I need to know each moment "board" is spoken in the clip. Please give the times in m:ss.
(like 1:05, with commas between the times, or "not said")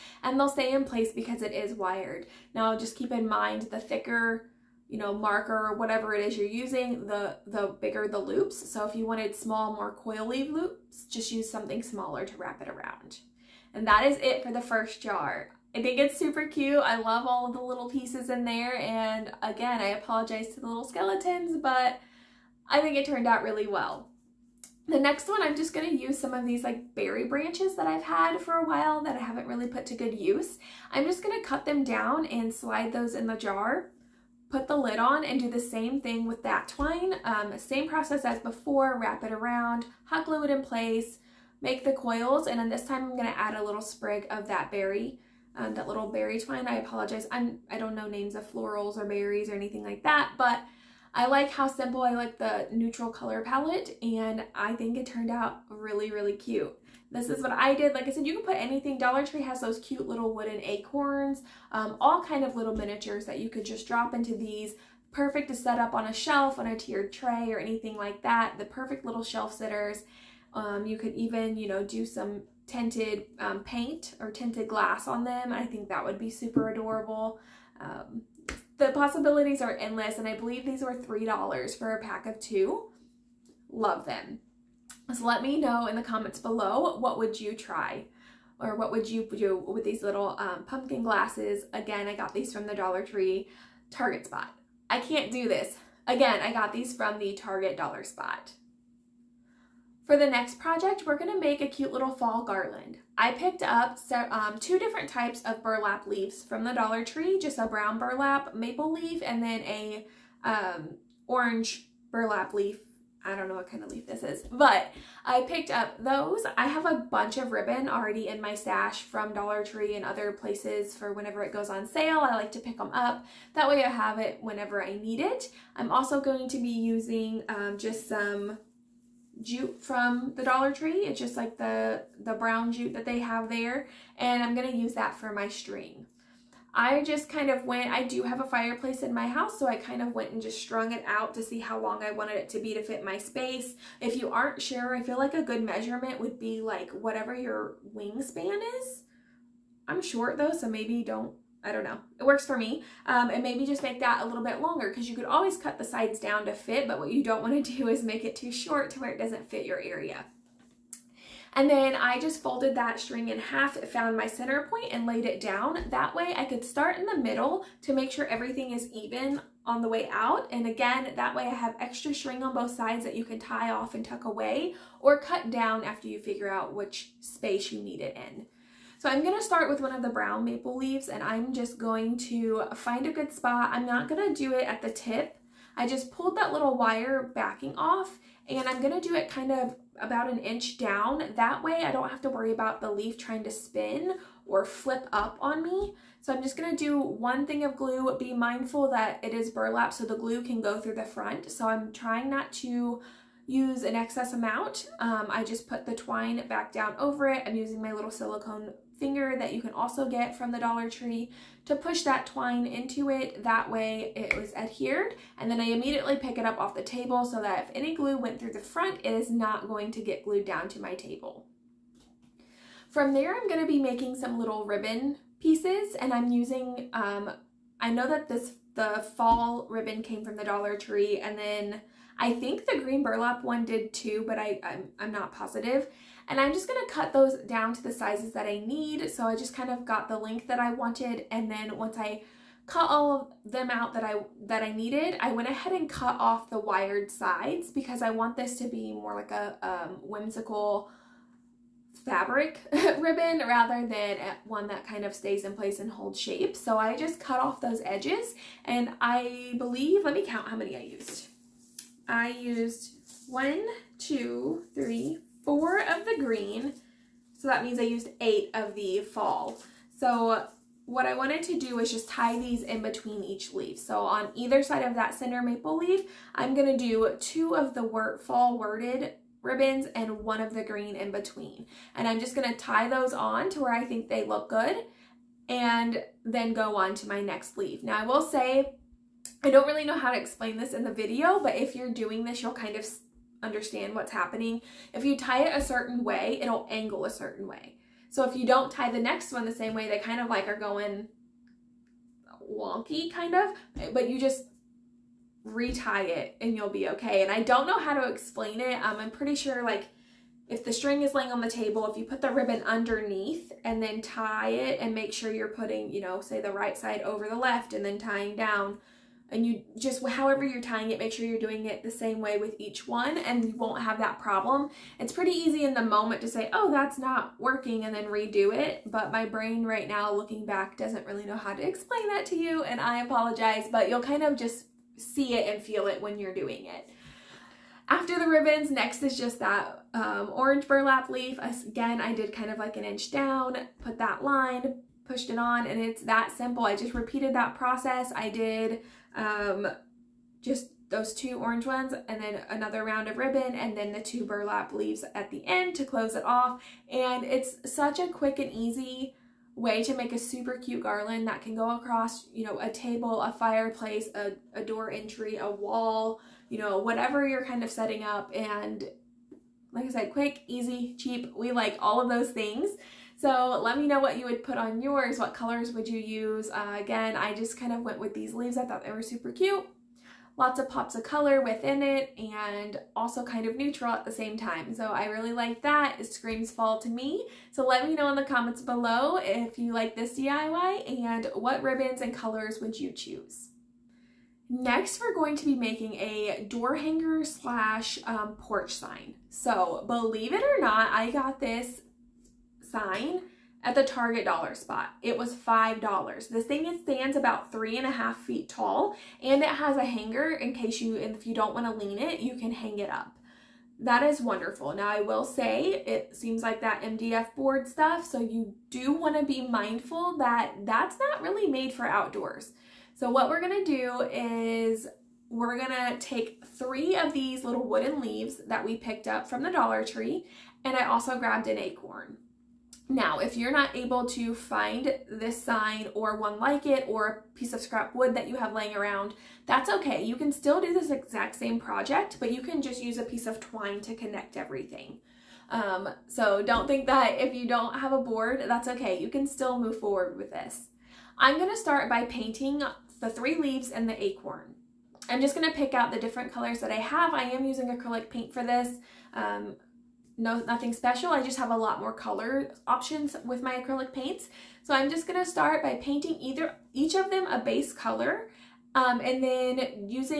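6:57, 7:27.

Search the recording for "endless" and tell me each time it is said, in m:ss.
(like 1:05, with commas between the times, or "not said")
1:19.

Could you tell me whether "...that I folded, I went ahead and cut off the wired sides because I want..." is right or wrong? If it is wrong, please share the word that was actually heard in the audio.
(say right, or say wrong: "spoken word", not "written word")
wrong: "needed", not "folded".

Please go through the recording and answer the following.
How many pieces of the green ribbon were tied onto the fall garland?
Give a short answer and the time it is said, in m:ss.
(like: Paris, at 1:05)
4, at 4:25.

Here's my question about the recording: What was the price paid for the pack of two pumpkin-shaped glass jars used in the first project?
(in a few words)
$3.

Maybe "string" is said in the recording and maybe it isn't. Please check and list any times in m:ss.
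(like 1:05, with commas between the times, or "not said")
2:15, 2:42, 2:52, 5:10.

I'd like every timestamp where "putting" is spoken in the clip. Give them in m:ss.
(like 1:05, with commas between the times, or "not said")
5:15.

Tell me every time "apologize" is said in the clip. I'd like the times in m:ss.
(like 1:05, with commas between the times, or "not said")
0:19, 0:46, 5:33.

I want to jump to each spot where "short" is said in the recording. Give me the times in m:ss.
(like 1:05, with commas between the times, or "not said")
2:30, 2:38.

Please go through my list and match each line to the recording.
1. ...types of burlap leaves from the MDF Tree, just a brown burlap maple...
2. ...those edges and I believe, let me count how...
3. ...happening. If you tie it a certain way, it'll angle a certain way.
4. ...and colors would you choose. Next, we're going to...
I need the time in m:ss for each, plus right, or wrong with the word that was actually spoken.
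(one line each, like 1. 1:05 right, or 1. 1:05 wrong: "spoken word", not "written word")
1. 1:45 wrong: "Dollar", not "MDF"
2. 4:17 right
3. 4:54 right
4. 6:32 right.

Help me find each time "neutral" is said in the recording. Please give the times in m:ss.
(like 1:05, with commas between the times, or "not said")
0:52, 6:23.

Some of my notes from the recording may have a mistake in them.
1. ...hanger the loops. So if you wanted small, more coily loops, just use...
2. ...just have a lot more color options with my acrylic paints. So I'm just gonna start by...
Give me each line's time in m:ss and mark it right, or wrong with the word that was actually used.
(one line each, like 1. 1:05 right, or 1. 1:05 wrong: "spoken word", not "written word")
1. 0:07 wrong: "bigger", not "hanger"
2. 7:41 right.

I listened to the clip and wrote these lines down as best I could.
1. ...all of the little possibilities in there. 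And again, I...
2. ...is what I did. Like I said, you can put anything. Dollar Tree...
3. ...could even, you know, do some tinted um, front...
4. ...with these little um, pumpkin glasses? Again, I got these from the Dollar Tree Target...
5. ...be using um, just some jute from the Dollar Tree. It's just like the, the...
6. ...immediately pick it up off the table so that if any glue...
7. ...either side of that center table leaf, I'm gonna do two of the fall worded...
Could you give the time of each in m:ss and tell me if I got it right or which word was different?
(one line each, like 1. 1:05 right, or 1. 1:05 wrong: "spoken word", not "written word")
1. 0:17 wrong: "pieces", not "possibilities"
2. 0:57 right
3. 1:10 wrong: "paint", not "front"
4. 1:29 right
5. 2:06 right
6. 3:35 right
7. 4:34 wrong: "maple", not "table".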